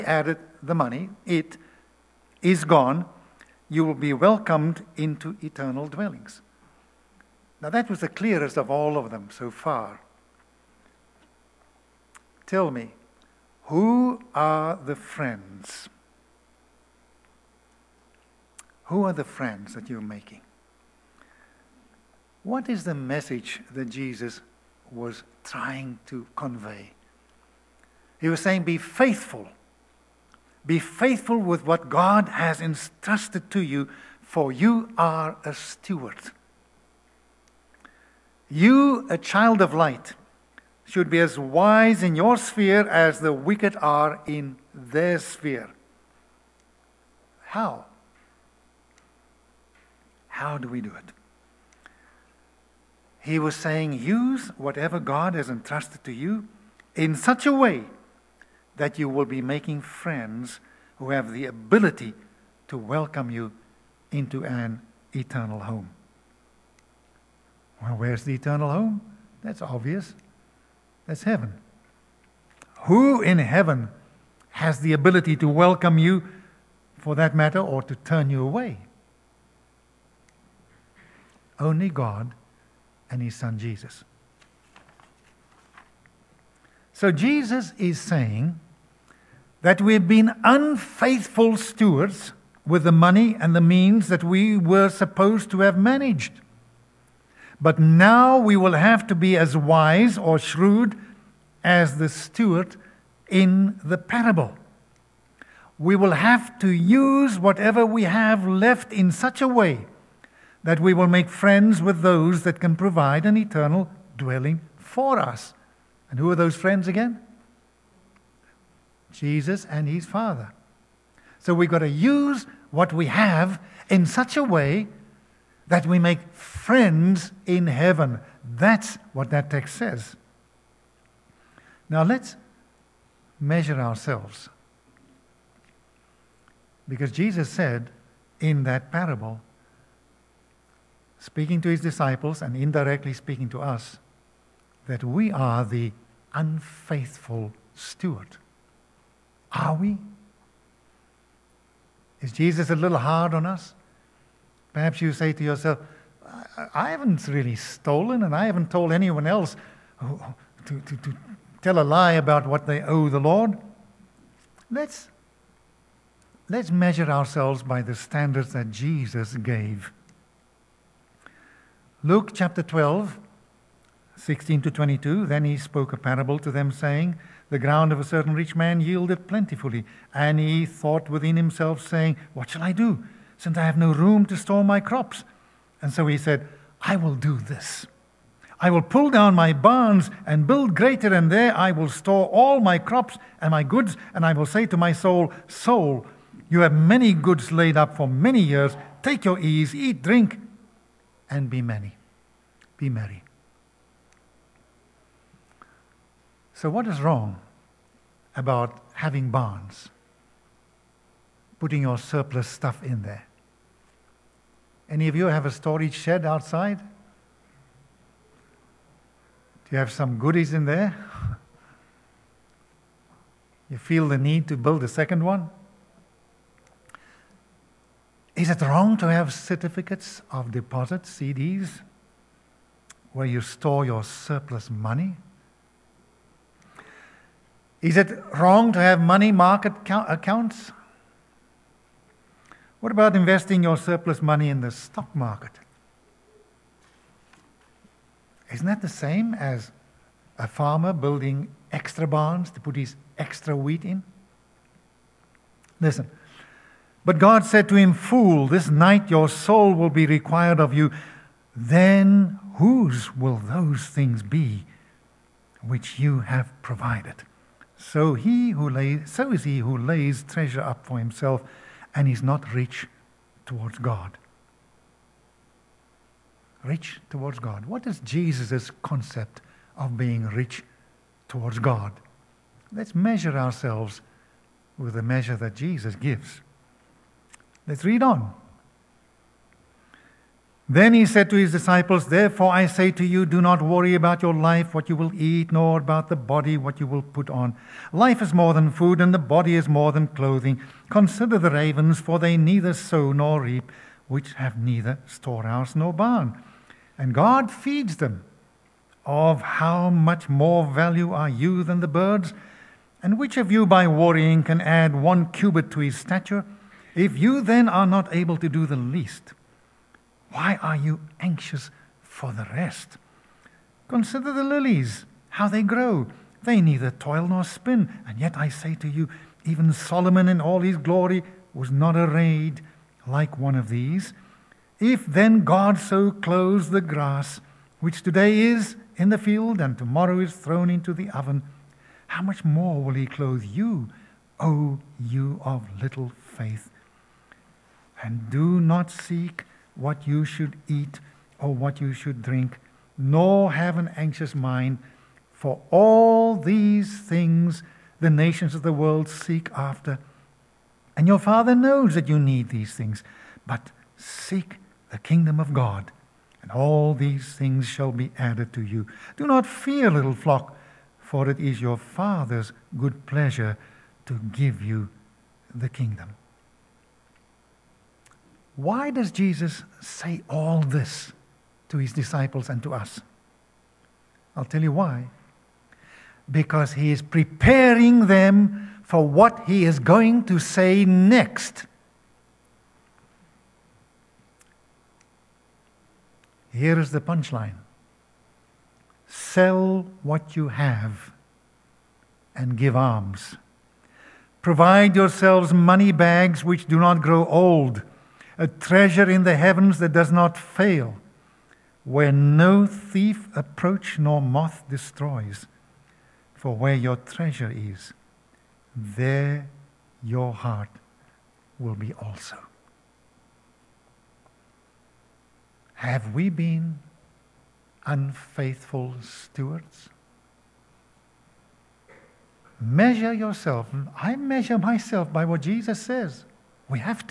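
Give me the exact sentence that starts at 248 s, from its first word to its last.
Isn't that the same as a farmer building extra barns to put his extra wheat in?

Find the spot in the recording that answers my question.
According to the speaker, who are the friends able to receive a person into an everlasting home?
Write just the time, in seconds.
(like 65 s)
119 s.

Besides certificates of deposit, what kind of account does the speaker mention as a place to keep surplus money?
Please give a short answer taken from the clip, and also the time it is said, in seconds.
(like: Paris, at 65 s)
money market accounts, at 238 s.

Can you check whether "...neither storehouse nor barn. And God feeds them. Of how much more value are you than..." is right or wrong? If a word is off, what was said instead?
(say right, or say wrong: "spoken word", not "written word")
right.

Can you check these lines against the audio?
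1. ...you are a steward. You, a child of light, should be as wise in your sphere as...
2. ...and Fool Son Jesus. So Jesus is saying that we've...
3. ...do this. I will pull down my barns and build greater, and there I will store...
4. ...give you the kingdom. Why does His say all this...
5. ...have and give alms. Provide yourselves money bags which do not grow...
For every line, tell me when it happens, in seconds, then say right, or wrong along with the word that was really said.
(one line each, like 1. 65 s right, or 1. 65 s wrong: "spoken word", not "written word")
1. 34 s right
2. 83 s wrong: "His", not "Fool"
3. 187 s right
4. 374 s wrong: "Jesus", not "His"
5. 400 s right.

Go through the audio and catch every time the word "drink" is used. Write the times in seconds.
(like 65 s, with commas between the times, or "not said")
200 s, 352 s.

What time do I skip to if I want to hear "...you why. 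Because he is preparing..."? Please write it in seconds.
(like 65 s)
384 s.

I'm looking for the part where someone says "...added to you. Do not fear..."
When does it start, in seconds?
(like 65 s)
368 s.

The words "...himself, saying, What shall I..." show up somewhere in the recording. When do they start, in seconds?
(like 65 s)
181 s.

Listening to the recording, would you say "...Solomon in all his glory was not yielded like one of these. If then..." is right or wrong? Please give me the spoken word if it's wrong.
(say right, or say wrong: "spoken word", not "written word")
wrong: "arrayed", not "yielded".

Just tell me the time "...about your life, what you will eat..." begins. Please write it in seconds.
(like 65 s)
293 s.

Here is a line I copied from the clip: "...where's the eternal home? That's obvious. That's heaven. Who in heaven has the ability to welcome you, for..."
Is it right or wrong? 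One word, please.
right.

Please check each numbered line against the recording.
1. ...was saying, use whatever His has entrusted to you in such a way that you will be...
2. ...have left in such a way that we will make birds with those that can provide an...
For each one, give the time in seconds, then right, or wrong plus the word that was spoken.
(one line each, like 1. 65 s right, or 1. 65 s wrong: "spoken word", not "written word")
1. 53 s wrong: "God", not "His"
2. 108 s wrong: "friends", not "birds".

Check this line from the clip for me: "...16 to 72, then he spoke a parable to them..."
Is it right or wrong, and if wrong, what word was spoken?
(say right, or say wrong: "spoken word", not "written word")
wrong: "22", not "72".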